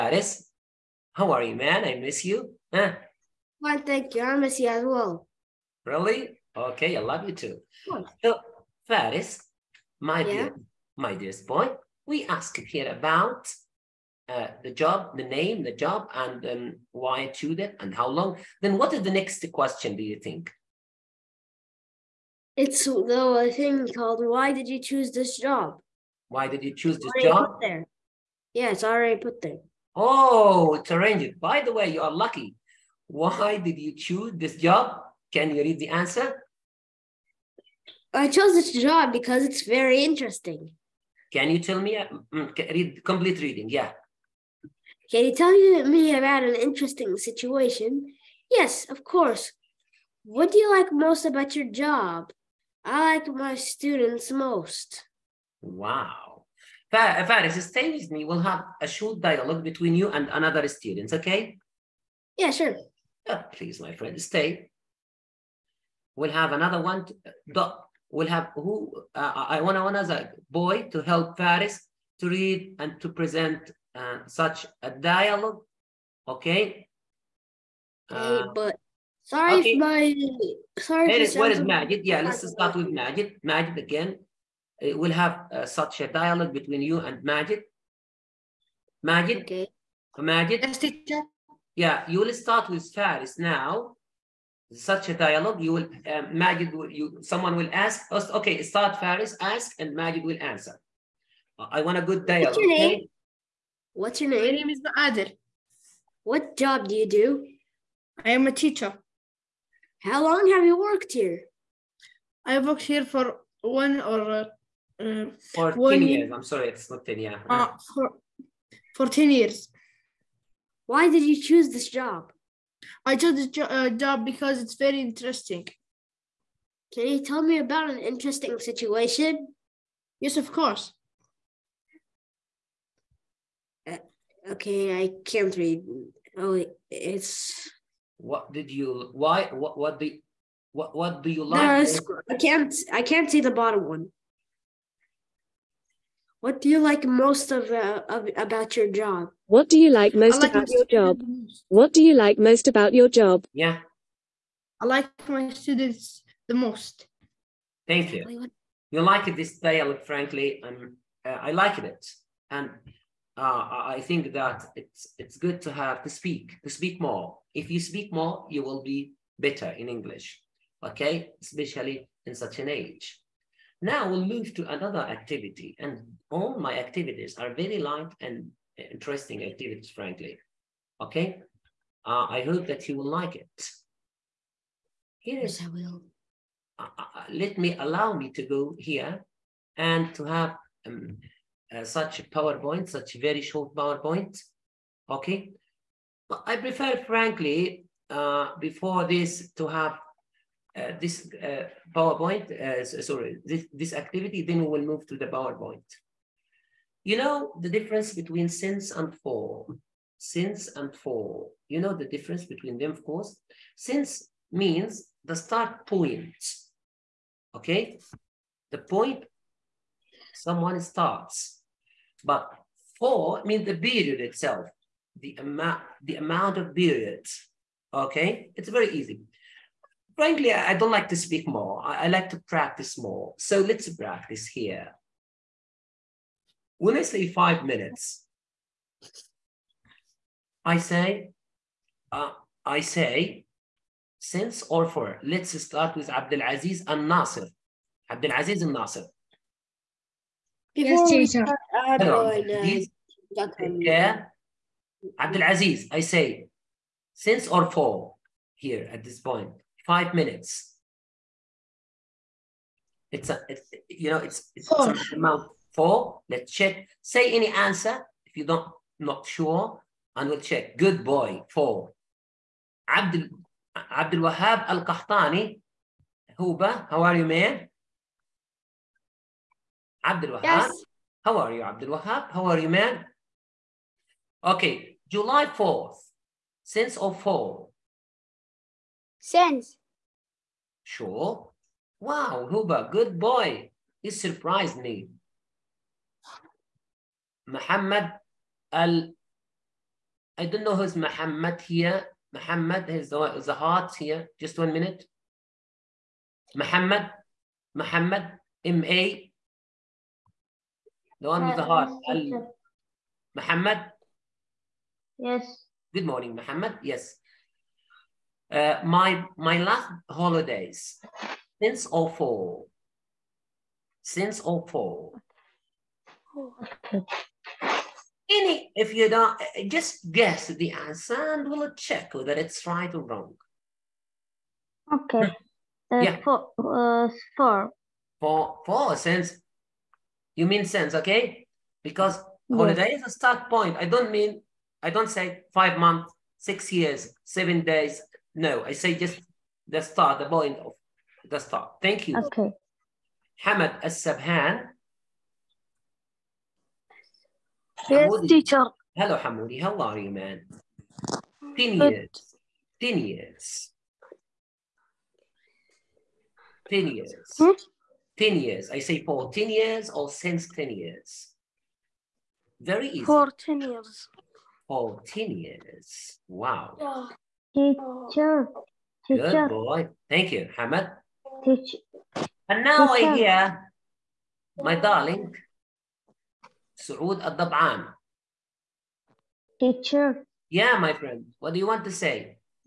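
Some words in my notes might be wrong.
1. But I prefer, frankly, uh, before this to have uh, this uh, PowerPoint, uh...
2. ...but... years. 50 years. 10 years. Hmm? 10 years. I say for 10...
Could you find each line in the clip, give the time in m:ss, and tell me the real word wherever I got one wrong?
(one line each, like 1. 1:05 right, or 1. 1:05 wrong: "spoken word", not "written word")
1. 3:16 right
2. 6:01 wrong: "10", not "50".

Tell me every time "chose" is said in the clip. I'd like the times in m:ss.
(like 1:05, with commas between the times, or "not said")
0:38, 2:03.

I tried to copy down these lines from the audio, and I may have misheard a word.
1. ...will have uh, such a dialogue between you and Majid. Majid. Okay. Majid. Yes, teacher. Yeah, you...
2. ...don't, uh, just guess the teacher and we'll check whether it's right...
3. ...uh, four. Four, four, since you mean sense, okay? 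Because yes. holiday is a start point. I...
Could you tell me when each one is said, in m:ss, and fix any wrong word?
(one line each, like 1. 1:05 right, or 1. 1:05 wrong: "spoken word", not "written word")
1. 1:24 right
2. 5:29 wrong: "answer", not "teacher"
3. 5:36 right.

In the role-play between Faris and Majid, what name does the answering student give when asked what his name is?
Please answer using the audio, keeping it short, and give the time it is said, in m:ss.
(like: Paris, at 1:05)
Adir, at 1:44.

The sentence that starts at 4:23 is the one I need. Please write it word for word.
It's a, it's, you know, it's, it's four.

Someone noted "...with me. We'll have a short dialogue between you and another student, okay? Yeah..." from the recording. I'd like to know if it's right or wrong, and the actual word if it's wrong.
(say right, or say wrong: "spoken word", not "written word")
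right.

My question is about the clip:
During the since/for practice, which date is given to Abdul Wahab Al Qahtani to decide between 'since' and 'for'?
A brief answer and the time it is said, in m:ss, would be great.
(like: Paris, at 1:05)
July 4th, at 4:45.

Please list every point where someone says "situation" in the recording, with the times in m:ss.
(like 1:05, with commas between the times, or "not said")
0:47, 2:08.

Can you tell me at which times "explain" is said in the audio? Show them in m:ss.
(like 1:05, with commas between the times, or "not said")
not said.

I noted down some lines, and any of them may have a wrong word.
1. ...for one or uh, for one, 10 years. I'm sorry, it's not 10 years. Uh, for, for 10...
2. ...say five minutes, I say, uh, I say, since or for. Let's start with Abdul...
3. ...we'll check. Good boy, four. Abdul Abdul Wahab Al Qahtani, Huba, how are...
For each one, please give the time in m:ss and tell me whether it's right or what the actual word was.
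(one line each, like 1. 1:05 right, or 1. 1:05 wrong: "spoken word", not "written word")
1. 1:53 right
2. 3:57 right
3. 4:30 right.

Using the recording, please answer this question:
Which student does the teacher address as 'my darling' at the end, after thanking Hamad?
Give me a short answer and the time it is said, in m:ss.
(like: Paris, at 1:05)
Saud al-Dab'an, at 6:26.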